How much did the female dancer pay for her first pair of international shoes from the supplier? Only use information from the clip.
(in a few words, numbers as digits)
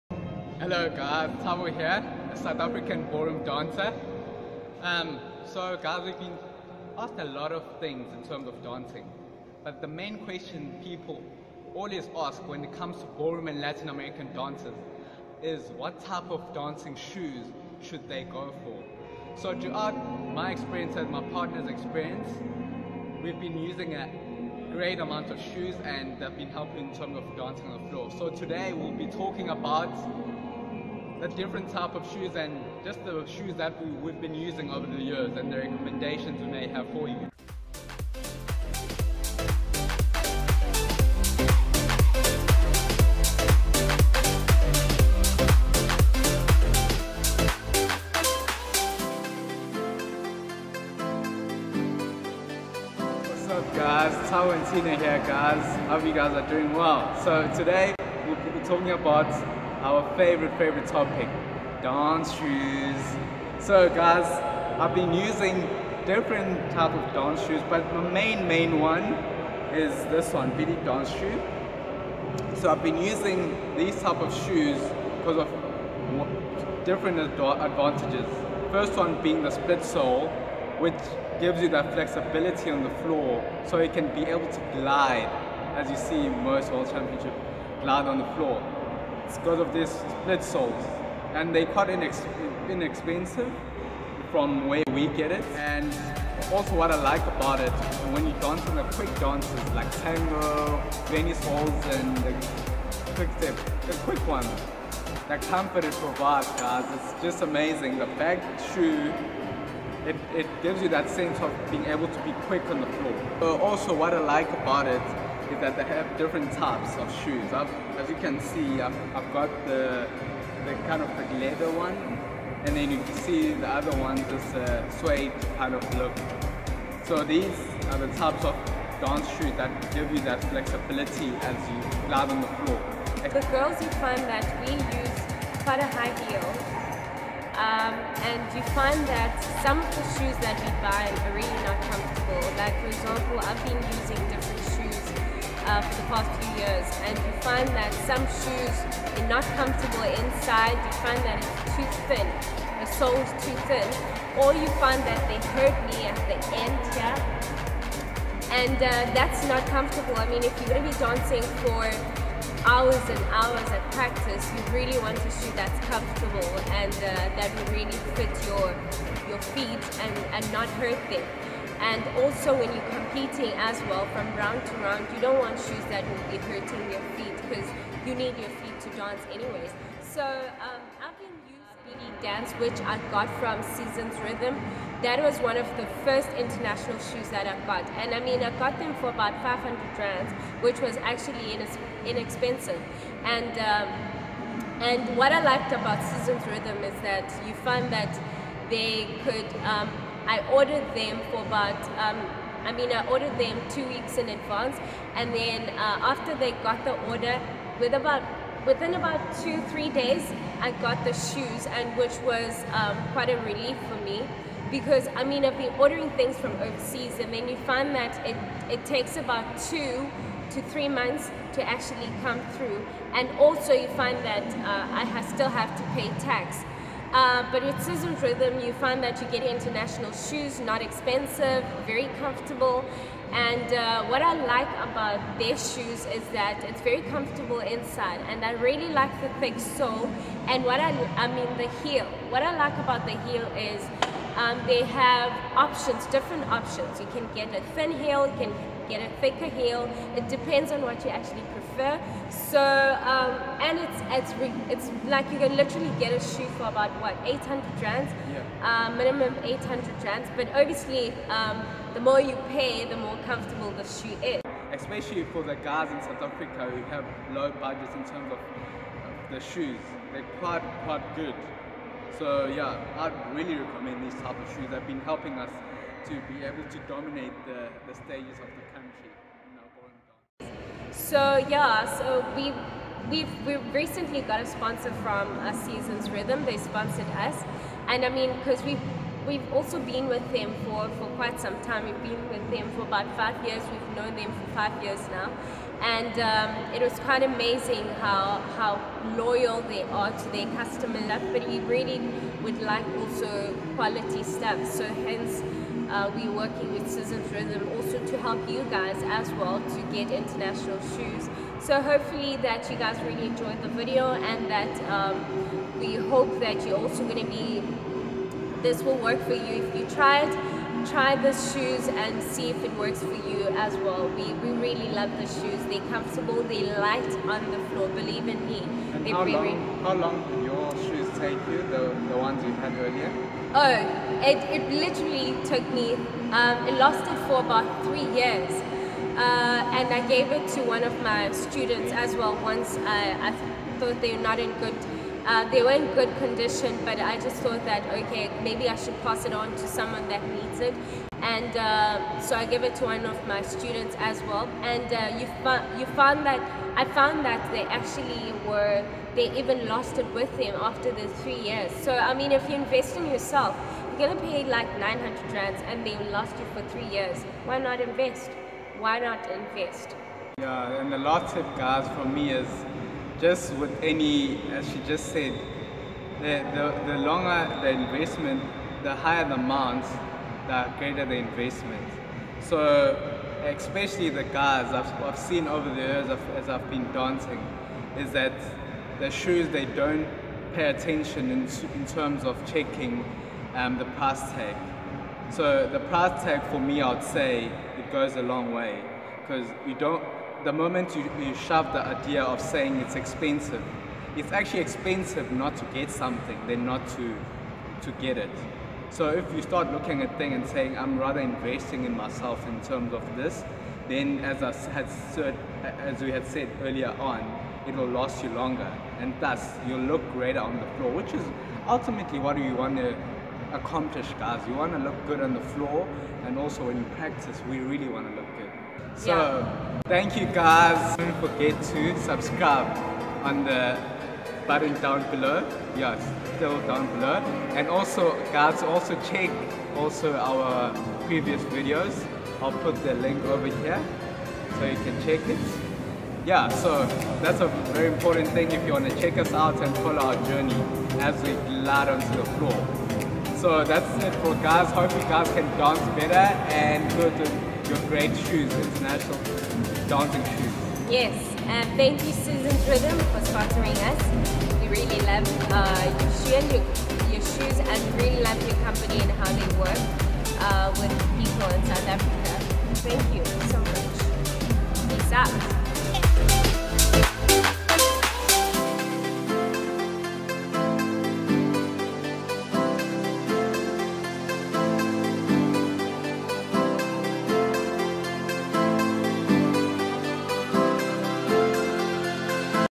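500 rands.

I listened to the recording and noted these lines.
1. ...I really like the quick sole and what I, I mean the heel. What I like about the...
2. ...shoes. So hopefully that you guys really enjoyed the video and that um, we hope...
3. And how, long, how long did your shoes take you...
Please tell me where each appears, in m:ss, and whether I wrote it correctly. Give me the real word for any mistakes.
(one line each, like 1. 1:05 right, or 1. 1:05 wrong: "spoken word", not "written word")
1. 3:58 wrong: "thick", not "quick"
2. 5:10 right
3. 5:28 right.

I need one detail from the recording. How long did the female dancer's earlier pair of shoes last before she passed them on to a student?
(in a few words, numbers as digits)
3 years.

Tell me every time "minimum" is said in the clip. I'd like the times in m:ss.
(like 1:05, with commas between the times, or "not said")
4:18.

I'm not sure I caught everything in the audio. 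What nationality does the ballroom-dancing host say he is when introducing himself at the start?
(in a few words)
South African.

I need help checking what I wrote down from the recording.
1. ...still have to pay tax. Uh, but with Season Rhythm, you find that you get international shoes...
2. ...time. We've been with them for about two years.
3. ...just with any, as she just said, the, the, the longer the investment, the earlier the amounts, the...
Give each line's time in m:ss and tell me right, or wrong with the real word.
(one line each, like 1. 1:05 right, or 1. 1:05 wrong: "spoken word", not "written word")
1. 3:45 right
2. 4:51 wrong: "five", not "two"
3. 6:13 wrong: "higher", not "earlier".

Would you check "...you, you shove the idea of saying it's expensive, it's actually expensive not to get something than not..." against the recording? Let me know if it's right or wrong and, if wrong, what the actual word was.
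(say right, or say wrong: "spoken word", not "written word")
right.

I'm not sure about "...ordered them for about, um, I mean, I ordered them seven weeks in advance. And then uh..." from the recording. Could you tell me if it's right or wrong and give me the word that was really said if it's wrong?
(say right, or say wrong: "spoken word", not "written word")
wrong: "two", not "seven".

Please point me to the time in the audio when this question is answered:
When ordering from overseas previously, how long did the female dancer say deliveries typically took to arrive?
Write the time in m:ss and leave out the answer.
3:39.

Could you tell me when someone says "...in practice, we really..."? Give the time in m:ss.
7:06.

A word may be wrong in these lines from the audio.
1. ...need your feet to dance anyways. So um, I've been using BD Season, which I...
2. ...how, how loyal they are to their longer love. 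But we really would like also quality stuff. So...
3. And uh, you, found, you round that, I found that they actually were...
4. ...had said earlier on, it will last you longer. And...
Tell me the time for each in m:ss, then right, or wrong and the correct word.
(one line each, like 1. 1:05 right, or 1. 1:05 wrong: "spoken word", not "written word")
1. 2:58 wrong: "Dance", not "Season"
2. 4:58 wrong: "customer", not "longer"
3. 5:54 wrong: "found", not "round"
4. 6:56 right.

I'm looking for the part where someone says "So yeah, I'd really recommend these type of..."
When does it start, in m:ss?
4:32.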